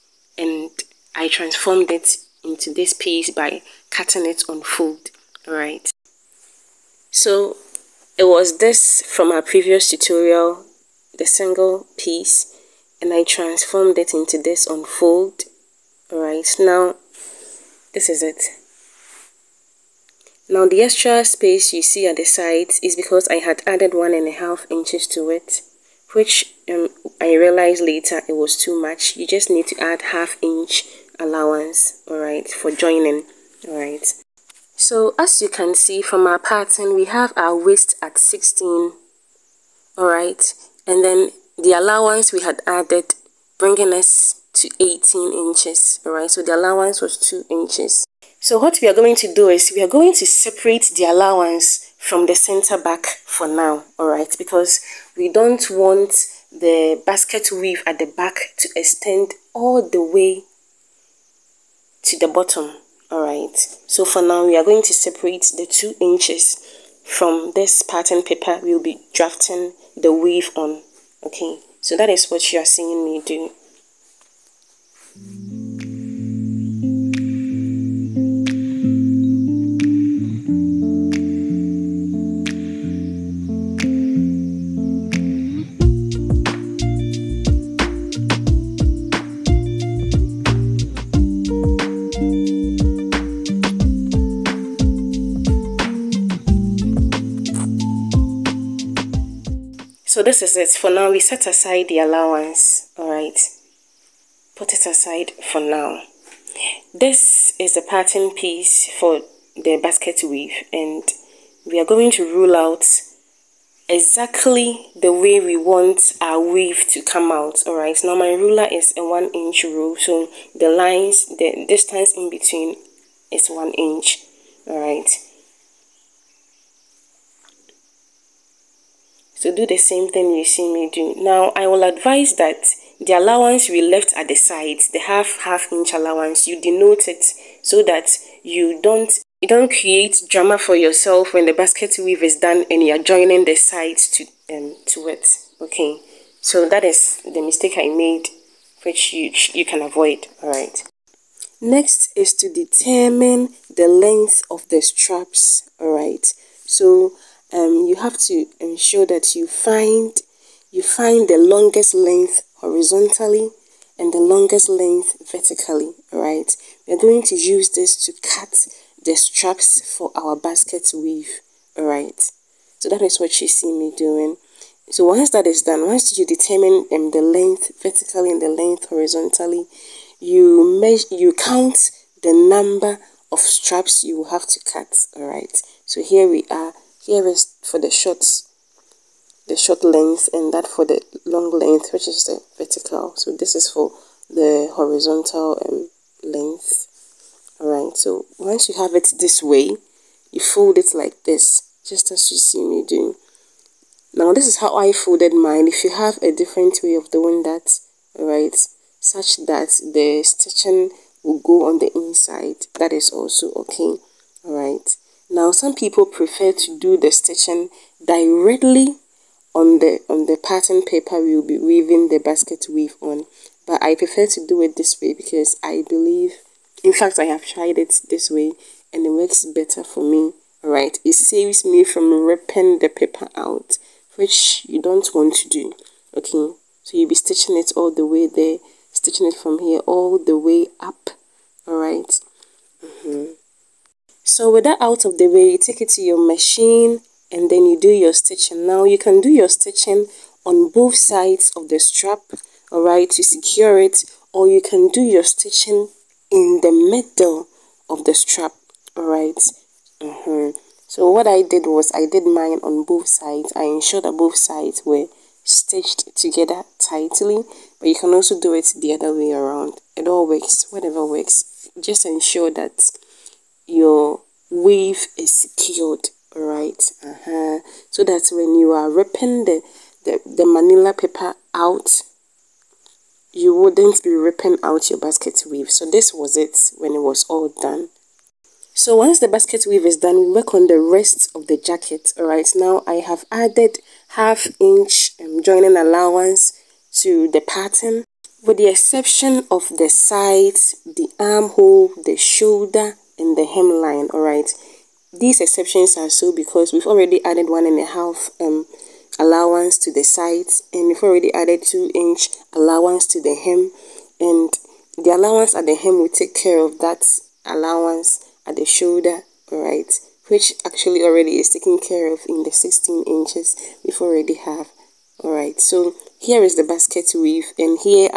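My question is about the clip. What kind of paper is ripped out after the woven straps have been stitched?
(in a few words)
manila paper.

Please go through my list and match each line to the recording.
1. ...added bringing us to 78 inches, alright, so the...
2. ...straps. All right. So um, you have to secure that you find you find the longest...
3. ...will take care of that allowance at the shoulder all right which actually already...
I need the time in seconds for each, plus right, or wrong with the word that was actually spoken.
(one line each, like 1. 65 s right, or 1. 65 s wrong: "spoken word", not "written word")
1. 42 s wrong: "18", not "78"
2. 154 s wrong: "ensure", not "secure"
3. 315 s right.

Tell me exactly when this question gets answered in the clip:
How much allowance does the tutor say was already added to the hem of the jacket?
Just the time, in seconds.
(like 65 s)
311 s.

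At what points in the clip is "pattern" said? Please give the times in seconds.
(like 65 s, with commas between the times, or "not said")
36 s, 67 s, 107 s, 220 s, 297 s.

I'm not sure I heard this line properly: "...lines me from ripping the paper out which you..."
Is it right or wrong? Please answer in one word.
wrong.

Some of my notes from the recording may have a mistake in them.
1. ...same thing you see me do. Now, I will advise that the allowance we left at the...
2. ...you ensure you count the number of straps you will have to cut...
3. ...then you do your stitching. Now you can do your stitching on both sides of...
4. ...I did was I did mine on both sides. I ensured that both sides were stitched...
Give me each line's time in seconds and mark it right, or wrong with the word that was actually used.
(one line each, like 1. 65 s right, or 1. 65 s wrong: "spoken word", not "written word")
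1. 129 s right
2. 180 s wrong: "measure", not "ensure"
3. 247 s right
4. 261 s right.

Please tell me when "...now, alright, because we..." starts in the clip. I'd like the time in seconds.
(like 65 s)
53 s.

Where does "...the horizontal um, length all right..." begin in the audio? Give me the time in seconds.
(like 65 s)
194 s.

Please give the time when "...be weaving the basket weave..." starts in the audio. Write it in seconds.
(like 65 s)
221 s.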